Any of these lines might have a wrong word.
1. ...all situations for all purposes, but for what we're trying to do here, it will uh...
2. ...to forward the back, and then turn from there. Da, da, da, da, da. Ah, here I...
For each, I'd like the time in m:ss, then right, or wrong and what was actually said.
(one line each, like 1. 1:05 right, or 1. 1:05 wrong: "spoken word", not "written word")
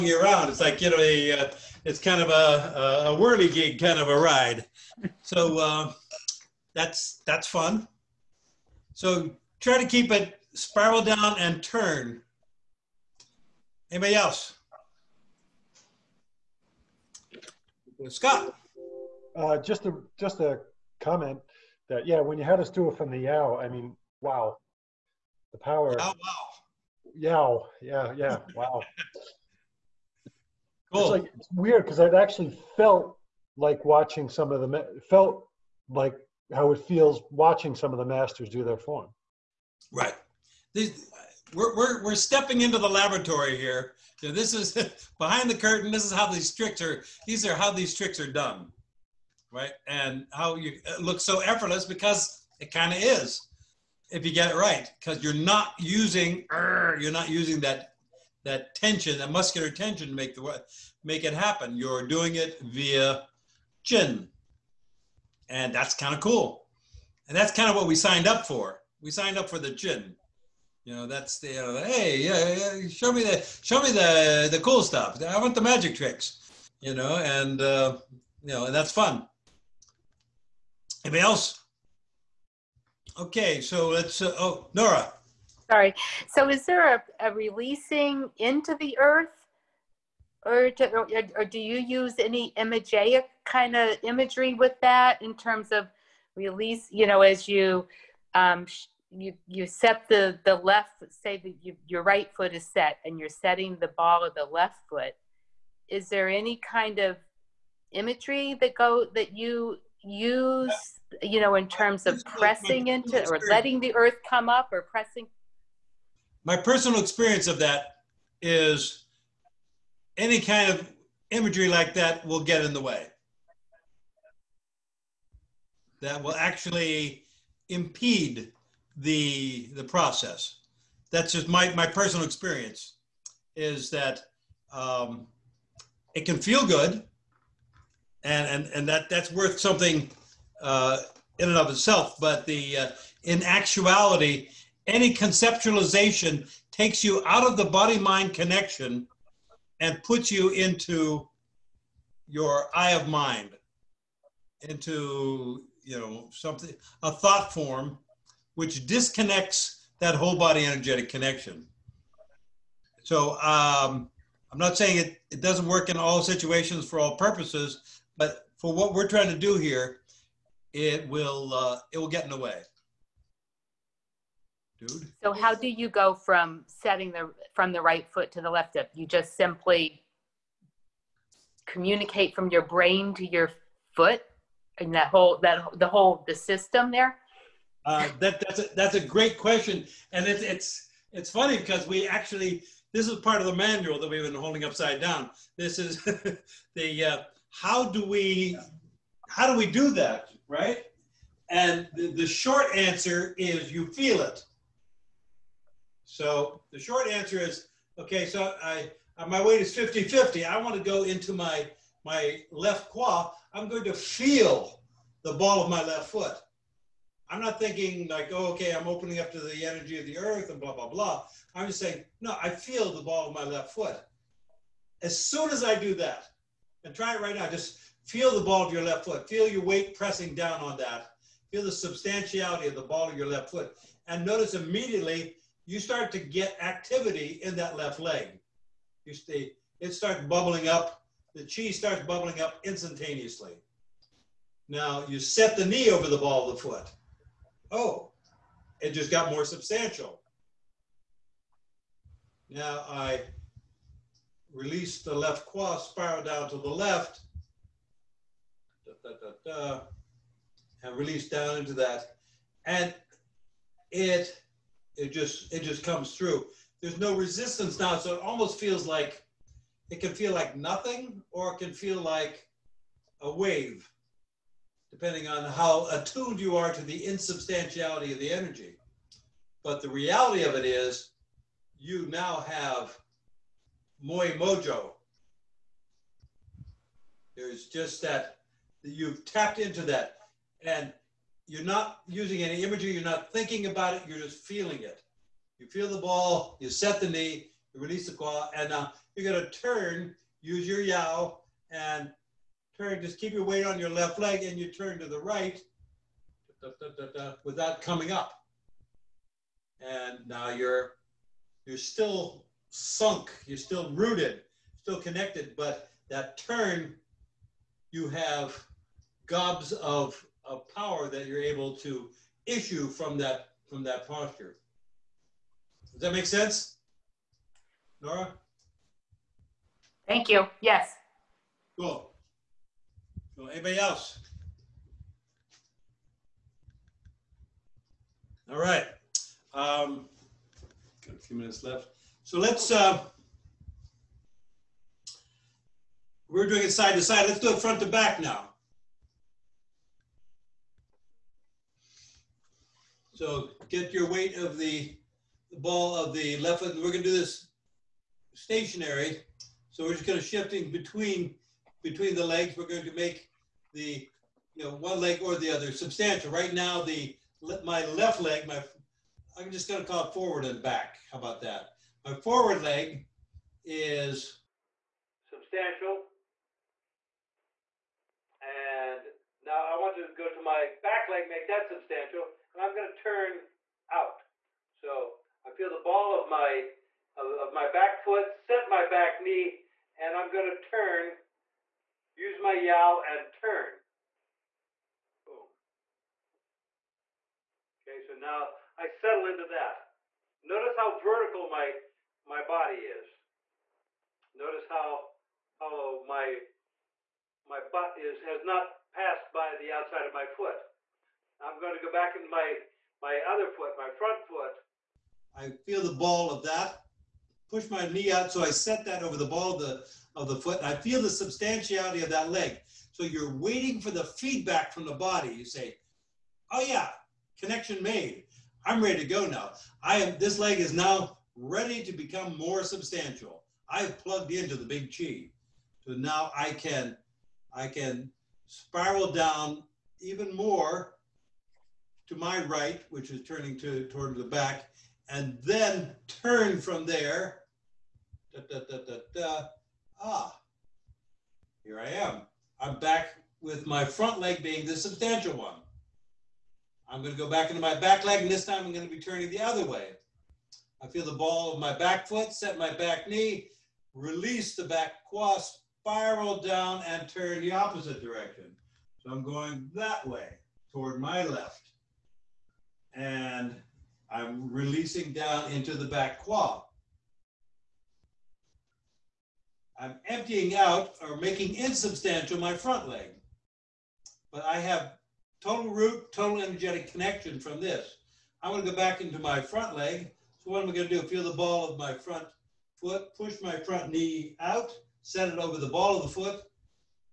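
1. 2:45 right
2. 7:23 wrong: "toward", not "forward".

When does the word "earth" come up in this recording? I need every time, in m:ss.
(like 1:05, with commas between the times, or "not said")
1:28, 1:53, 3:40.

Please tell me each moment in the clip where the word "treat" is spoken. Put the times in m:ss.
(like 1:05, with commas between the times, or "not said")
not said.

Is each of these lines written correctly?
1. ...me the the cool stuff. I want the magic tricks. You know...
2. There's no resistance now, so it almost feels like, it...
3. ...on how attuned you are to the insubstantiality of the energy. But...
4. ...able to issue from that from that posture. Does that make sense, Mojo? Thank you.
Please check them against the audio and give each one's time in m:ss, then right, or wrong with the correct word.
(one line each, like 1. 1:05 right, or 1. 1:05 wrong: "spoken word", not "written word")
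1. 1:13 right
2. 4:26 right
3. 4:35 right
4. 5:21 wrong: "Nora", not "Mojo".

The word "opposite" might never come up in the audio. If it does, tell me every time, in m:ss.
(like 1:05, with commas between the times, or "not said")
7:47.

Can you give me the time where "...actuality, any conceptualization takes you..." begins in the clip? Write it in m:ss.
2:23.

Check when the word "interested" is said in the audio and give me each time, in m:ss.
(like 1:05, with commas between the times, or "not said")
not said.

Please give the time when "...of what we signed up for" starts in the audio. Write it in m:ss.
1:07.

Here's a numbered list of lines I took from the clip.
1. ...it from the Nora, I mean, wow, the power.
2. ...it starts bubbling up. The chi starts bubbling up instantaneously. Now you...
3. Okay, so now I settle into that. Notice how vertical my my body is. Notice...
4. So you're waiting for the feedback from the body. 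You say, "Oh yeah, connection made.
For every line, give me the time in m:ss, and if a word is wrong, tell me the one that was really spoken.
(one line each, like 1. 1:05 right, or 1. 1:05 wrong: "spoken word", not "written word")
1. 0:22 wrong: "Yao", not "Nora"
2. 3:59 right
3. 6:37 right
4. 7:02 right.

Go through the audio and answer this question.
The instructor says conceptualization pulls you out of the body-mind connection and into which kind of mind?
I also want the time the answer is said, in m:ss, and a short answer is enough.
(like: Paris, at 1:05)
eye of mind, at 2:32.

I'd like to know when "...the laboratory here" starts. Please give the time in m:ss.
0:42.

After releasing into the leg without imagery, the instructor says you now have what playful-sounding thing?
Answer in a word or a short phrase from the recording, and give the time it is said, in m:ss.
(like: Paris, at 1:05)
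Moy Mojo, at 4:44.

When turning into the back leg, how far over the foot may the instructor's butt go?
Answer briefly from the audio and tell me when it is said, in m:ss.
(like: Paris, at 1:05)
the outside, at 6:49.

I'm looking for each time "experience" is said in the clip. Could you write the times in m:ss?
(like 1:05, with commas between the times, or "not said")
1:56, 2:12.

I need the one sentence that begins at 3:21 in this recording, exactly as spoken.
And the, the short answer is you feel it.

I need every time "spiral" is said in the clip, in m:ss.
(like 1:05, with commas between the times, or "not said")
0:10, 4:15, 7:18, 7:45.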